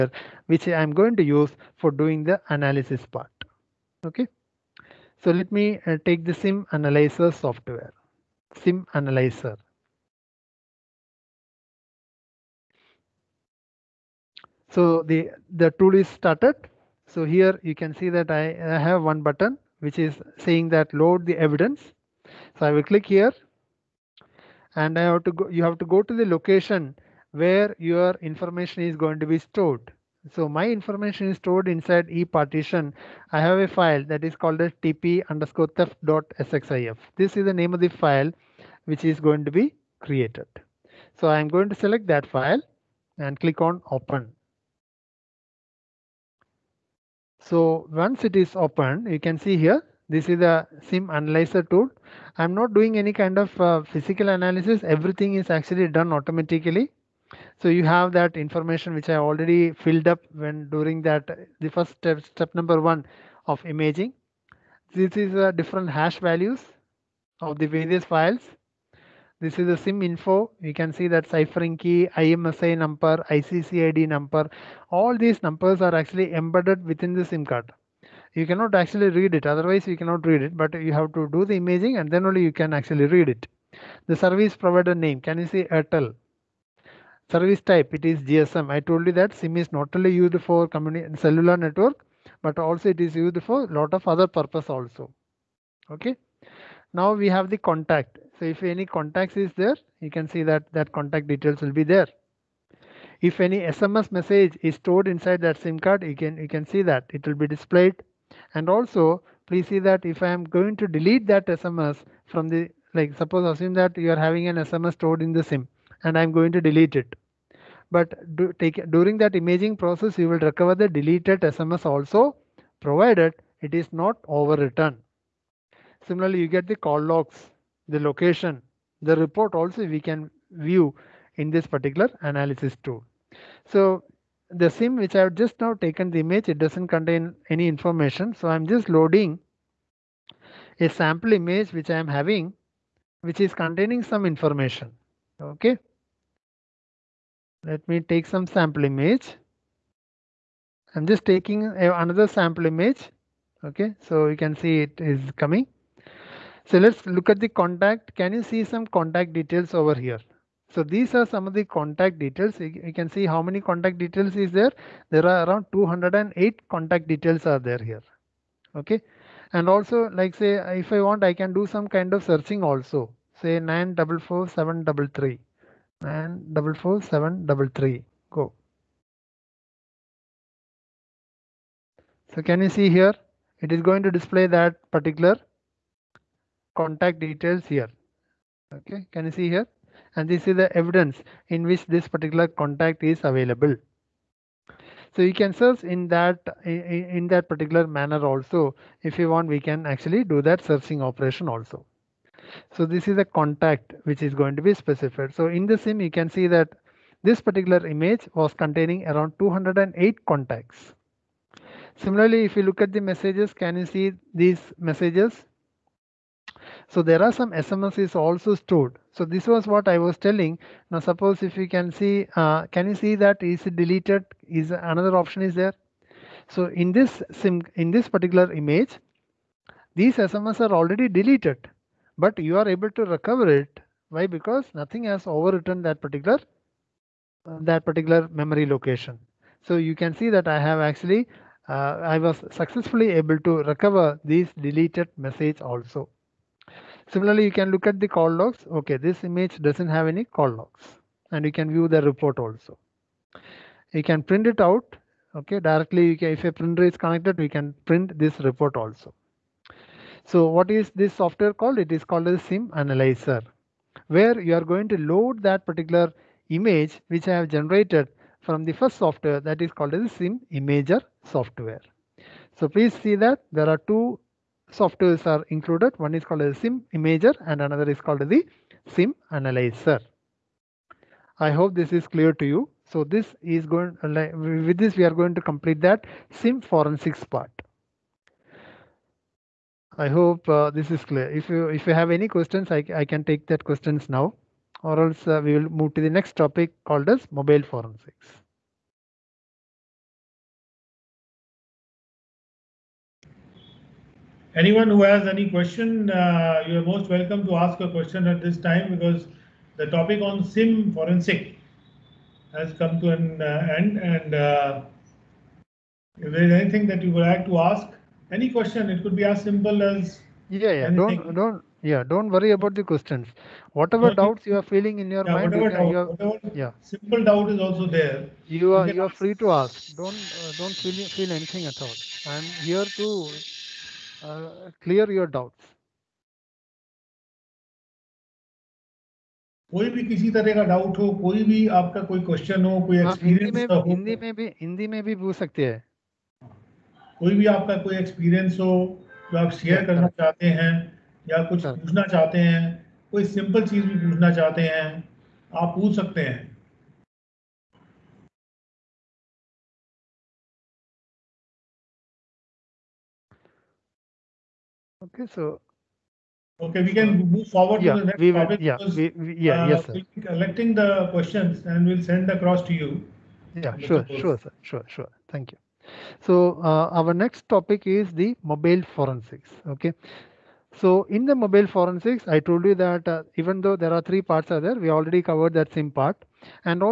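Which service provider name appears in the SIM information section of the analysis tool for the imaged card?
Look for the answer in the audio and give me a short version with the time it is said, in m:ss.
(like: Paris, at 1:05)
Airtel, at 1:25.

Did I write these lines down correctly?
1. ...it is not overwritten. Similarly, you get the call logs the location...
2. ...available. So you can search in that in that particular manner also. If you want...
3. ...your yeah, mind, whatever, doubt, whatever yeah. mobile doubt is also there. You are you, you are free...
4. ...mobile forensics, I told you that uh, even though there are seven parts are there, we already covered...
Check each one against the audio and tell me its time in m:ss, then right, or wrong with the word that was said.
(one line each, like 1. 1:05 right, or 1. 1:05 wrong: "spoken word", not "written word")
1. 2:03 right
2. 3:13 right
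3. 5:25 wrong: "simple", not "mobile"
4. 6:21 wrong: "three", not "seven".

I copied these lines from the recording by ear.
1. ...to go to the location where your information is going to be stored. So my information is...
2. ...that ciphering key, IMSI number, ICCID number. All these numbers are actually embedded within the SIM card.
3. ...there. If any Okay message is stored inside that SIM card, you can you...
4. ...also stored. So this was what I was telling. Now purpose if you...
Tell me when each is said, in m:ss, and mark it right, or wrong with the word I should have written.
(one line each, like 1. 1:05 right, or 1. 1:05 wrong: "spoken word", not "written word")
1. 0:25 right
2. 1:11 right
3. 1:41 wrong: "SMS", not "Okay"
4. 3:38 wrong: "suppose", not "purpose".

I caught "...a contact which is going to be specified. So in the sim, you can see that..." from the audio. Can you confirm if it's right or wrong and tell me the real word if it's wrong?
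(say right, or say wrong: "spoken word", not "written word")
right.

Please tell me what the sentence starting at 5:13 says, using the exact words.
And uh, if there is anything that you would like to ask, any question, it could be as simple as yeah, yeah.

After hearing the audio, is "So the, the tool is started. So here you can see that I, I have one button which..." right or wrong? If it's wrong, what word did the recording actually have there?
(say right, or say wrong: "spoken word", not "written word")
right.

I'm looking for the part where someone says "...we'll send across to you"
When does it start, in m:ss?
6:11.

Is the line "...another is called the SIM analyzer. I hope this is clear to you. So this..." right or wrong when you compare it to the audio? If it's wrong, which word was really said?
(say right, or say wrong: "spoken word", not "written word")
right.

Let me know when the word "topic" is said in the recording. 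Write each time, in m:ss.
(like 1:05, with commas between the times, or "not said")
4:56, 5:09, 6:17.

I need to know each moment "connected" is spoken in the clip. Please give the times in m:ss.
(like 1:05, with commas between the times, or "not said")
4:16.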